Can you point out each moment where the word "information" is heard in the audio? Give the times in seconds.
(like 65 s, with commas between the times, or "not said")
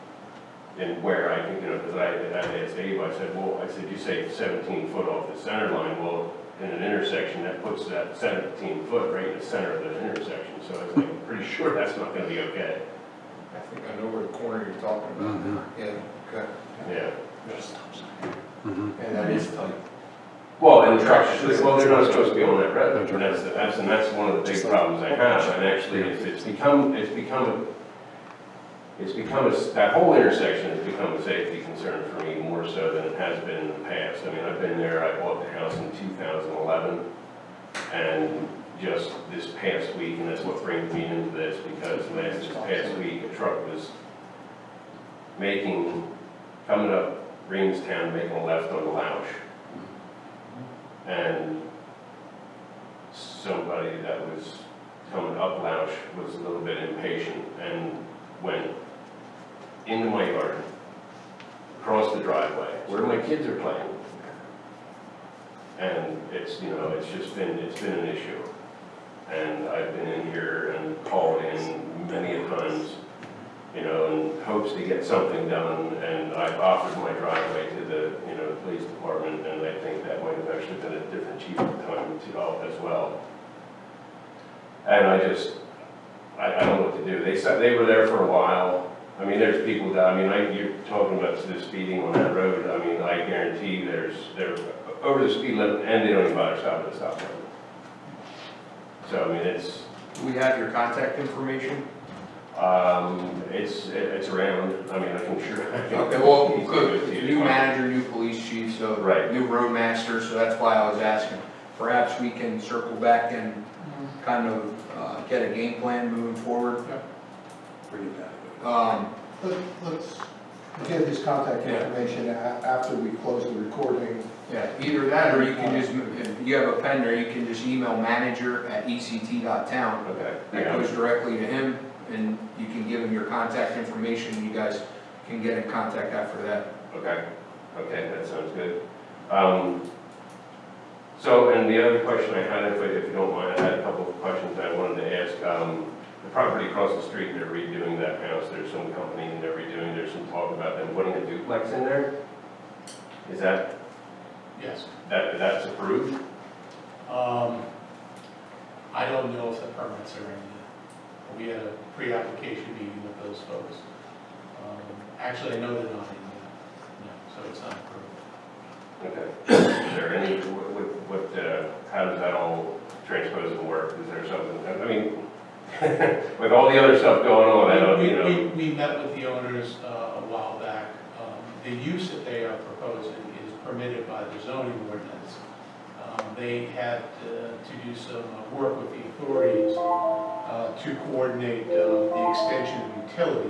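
101 s, 121 s, 133 s.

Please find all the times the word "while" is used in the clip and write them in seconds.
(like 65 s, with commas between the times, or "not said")
88 s, 180 s.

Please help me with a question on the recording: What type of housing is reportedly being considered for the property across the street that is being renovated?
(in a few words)
A duplex.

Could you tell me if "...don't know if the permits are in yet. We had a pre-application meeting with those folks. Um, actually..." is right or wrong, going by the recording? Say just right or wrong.
right.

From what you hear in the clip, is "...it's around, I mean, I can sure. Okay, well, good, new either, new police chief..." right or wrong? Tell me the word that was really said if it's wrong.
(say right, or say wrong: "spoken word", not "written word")
wrong: "manager", not "either".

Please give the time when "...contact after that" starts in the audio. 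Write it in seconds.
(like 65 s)
135 s.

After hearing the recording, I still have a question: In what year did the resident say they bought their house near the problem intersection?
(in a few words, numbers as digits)
2011.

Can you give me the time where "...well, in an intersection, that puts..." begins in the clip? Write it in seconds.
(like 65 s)
6 s.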